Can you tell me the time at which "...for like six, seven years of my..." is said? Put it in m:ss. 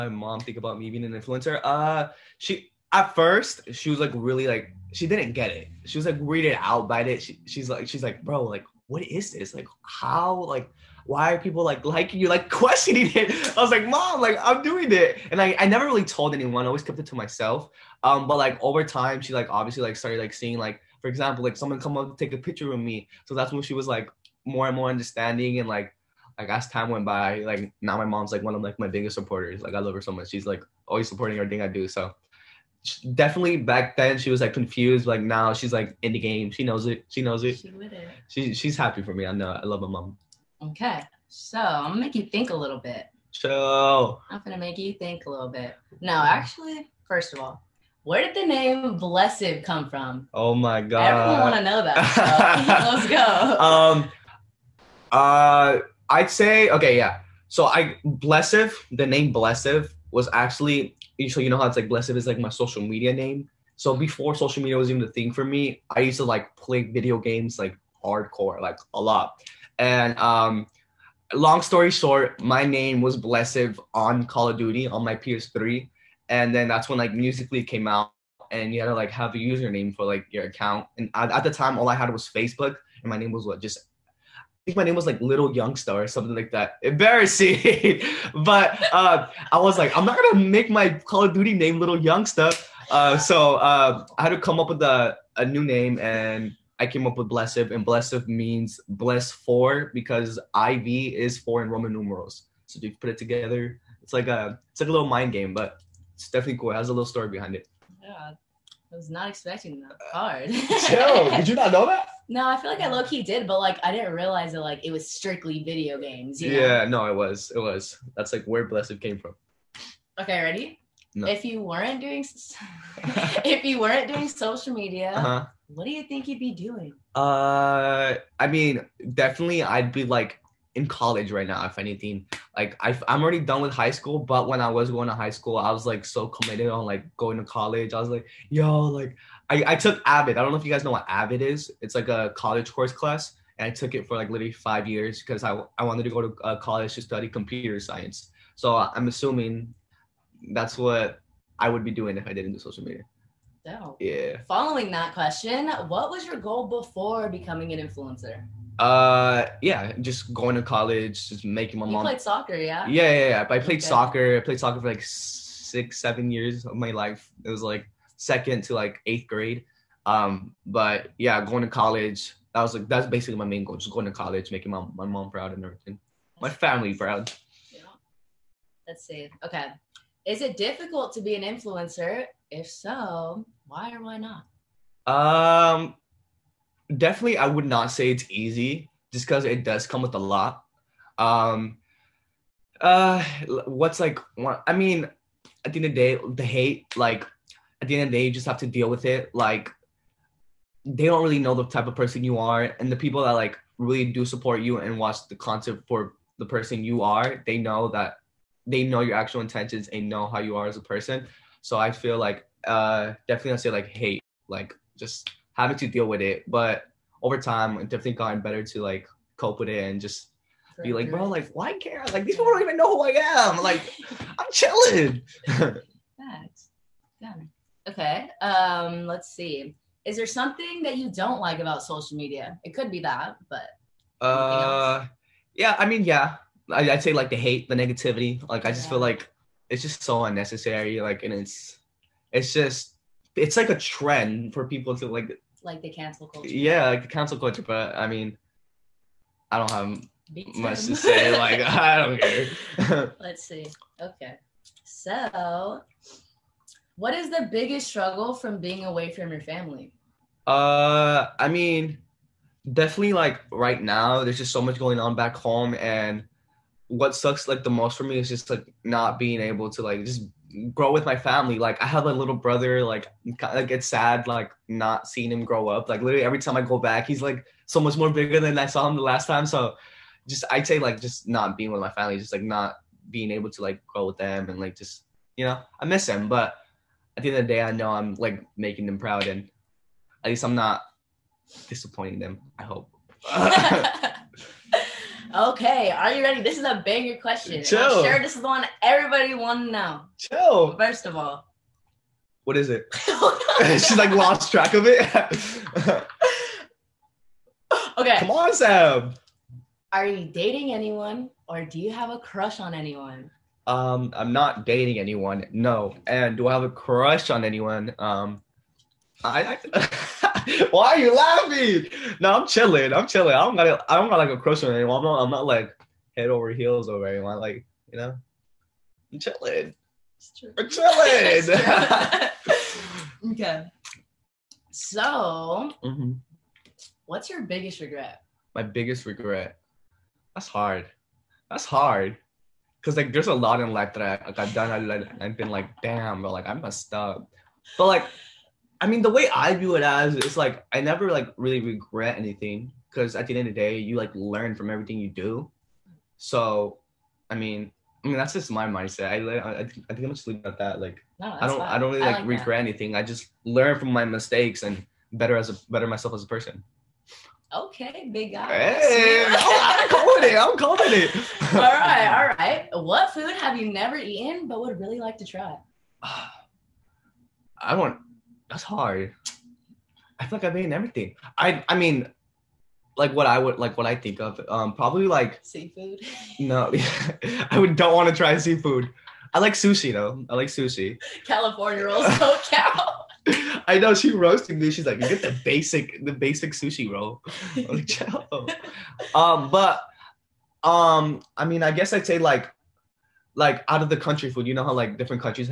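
2:44.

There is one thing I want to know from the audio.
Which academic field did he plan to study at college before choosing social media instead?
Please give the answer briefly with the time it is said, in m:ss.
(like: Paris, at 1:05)
Computer science, at 2:27.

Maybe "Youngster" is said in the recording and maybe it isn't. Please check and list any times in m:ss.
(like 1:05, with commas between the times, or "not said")
1:25, 1:31.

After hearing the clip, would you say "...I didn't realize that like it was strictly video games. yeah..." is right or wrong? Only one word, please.
right.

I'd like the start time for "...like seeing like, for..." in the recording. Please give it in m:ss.
0:20.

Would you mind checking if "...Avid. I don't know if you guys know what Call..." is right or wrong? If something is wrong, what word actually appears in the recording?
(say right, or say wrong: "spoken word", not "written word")
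wrong: "Avid", not "Call".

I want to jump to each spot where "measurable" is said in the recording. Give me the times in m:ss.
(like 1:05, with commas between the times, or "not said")
not said.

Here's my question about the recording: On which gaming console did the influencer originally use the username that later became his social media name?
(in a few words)
PS3.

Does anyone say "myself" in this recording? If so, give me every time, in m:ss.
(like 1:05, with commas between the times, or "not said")
0:17, 6:05.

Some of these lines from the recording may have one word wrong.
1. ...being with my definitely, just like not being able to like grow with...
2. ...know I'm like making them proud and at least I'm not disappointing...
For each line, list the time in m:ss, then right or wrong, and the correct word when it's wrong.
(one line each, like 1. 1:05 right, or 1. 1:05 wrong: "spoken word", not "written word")
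1. 4:41 wrong: "family", not "definitely"
2. 4:47 right.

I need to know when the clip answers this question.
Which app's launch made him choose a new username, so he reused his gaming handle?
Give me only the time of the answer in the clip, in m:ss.
1:17.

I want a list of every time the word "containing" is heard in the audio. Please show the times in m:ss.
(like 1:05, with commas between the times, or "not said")
not said.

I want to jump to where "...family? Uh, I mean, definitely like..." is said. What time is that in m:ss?
4:19.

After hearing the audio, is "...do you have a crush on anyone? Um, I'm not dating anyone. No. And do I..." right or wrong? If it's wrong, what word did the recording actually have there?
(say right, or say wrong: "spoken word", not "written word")
right.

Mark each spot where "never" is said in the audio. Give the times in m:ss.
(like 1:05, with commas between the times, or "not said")
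0:15, 5:50, 6:13.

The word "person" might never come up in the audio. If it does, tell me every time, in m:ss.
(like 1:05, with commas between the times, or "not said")
3:21, 3:26, 3:30, 6:06.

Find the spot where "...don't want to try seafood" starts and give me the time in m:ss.
6:27.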